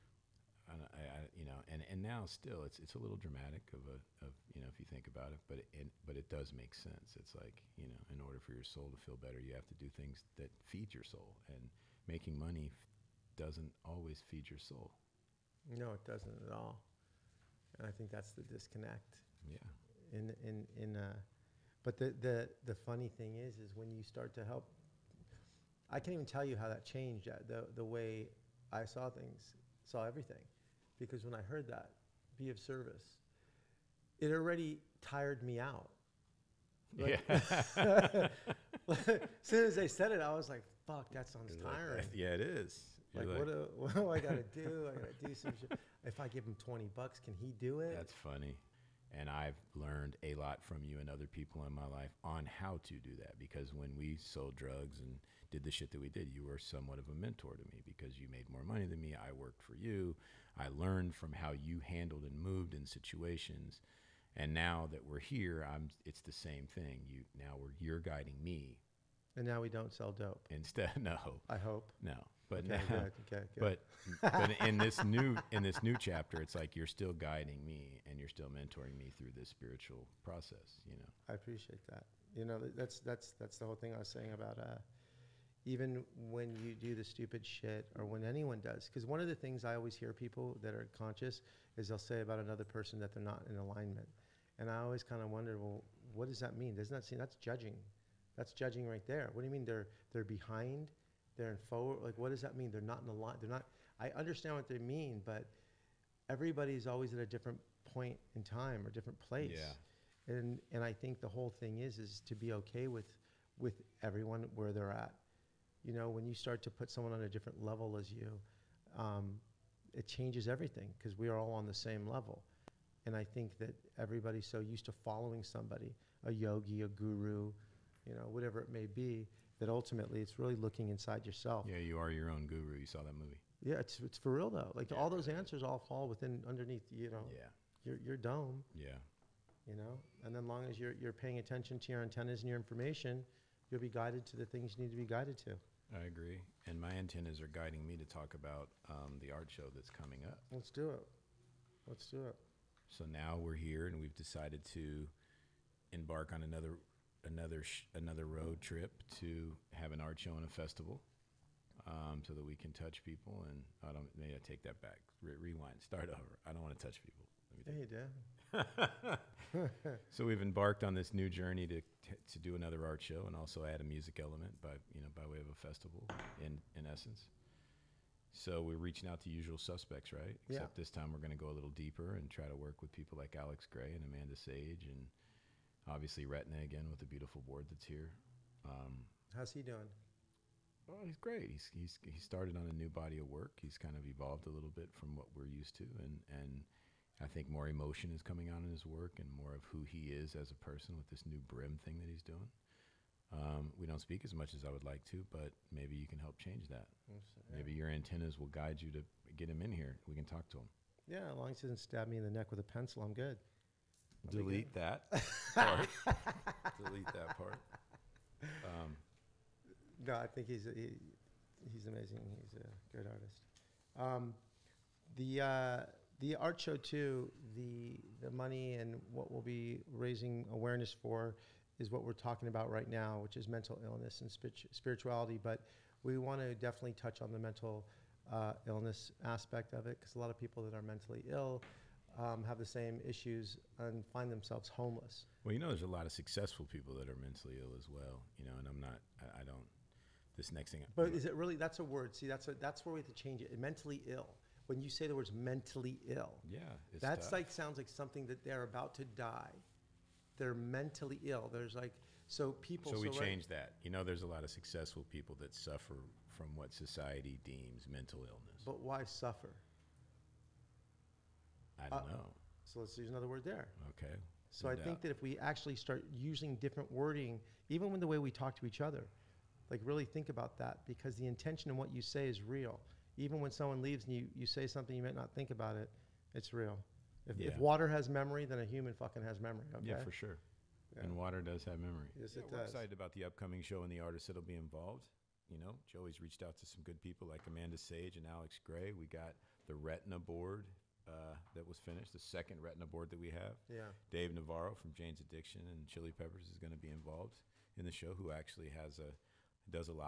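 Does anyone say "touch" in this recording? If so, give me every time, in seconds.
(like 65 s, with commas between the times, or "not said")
162 s, 166 s, 236 s.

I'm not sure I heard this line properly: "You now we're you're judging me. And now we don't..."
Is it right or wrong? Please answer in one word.
wrong.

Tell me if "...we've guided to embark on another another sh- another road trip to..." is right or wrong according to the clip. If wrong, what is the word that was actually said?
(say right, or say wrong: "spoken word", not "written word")
wrong: "decided", not "guided".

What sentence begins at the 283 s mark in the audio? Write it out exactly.
Even when someone leaves and you, you say something you might not think about it, it's real.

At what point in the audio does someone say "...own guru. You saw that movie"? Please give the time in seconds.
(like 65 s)
132 s.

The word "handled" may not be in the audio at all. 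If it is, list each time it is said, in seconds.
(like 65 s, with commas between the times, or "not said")
61 s.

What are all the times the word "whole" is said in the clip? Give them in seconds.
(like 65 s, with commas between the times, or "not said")
83 s, 111 s.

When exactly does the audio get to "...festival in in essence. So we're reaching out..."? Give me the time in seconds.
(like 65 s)
175 s.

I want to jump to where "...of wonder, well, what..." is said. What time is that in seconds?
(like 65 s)
95 s.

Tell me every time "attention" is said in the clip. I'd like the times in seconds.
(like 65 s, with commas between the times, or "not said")
141 s.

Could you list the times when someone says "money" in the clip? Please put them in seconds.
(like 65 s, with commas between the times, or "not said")
12 s, 58 s, 228 s.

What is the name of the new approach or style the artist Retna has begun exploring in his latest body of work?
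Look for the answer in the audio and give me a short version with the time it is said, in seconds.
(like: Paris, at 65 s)
brim, at 201 s.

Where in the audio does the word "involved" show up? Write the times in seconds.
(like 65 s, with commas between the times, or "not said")
294 s, 306 s.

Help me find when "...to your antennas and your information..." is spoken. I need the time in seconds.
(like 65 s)
141 s.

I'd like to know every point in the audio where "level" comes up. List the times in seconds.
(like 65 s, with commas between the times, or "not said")
117 s, 122 s.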